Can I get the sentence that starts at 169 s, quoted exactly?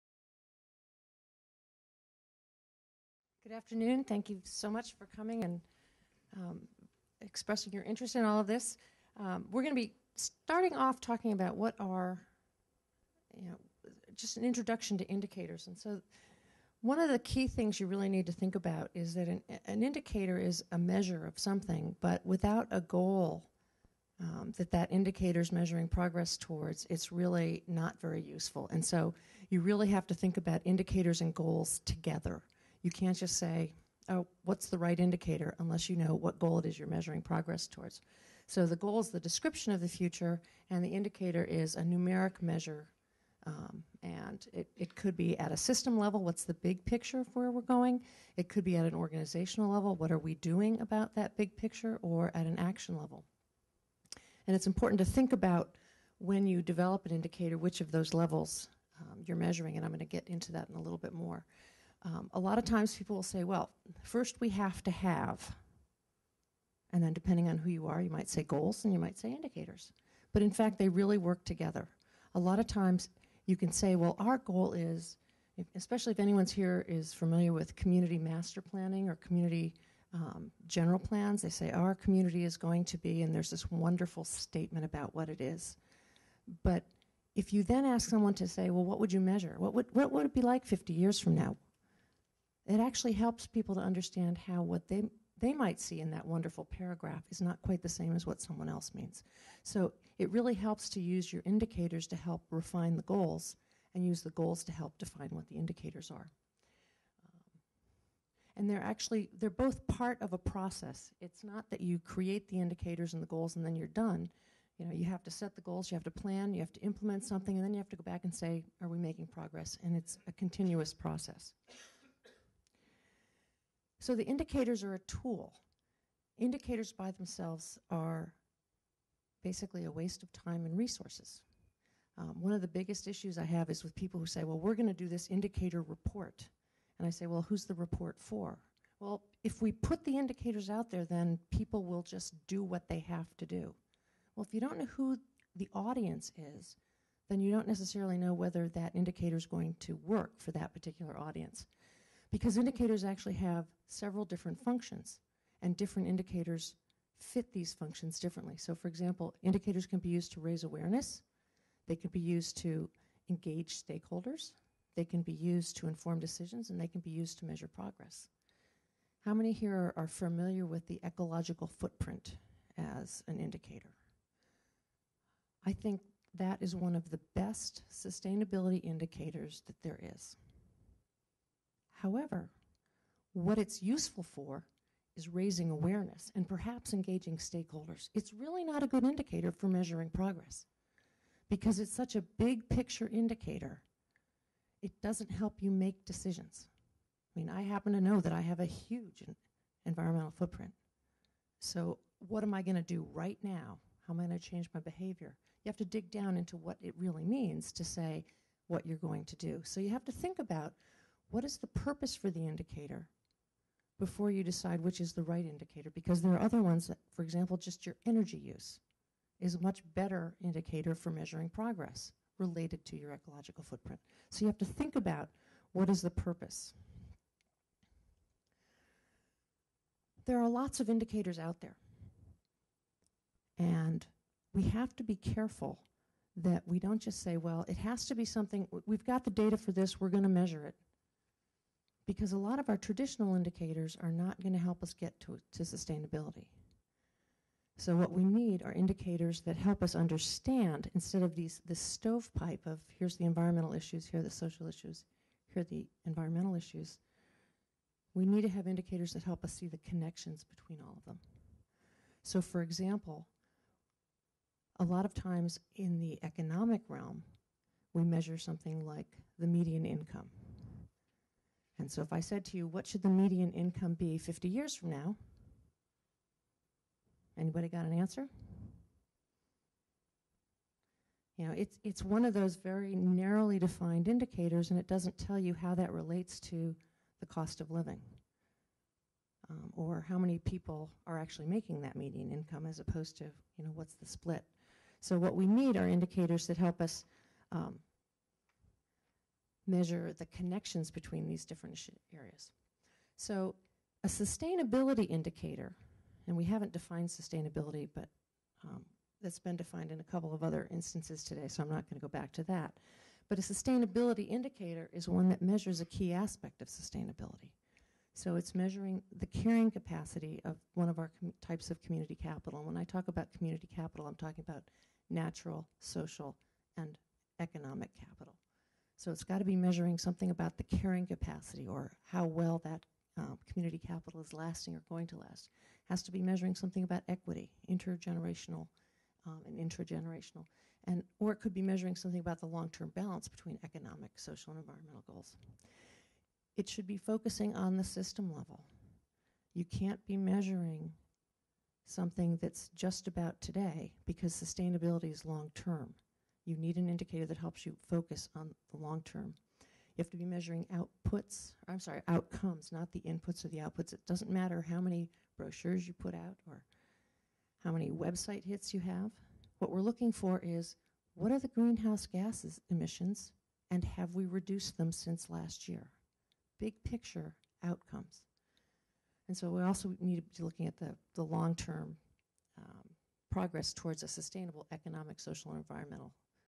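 How many here are, are familiar with the ecological footprint as an indicator?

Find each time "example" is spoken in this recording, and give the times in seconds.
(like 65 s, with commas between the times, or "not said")
158 s, 217 s, 262 s.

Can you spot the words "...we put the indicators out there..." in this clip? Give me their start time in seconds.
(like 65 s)
139 s.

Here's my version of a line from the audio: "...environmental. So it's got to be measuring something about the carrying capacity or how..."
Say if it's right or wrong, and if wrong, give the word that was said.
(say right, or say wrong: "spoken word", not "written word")
wrong: "capital", not "environmental".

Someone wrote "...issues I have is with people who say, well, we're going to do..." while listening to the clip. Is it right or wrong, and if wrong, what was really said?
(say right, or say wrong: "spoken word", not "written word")
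right.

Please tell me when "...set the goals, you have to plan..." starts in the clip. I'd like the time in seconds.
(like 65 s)
115 s.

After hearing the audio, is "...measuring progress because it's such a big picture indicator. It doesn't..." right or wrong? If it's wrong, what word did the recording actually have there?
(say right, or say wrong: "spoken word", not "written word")
right.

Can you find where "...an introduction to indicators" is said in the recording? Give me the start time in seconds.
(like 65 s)
14 s.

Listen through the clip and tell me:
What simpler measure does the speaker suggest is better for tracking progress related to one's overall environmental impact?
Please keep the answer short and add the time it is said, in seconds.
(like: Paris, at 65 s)
energy use, at 218 s.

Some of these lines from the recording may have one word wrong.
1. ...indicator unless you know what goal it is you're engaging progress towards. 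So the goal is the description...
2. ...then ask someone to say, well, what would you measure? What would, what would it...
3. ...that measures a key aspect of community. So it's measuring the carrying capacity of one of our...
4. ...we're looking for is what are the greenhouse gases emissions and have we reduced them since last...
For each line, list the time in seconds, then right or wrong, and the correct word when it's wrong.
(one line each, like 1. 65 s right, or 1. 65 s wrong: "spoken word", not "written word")
1. 34 s wrong: "measuring", not "engaging"
2. 87 s right
3. 315 s wrong: "sustainability", not "community"
4. 369 s right.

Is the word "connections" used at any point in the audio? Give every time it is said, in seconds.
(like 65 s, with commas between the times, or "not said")
259 s, 300 s.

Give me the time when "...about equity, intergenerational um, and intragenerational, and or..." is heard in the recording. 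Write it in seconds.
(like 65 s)
336 s.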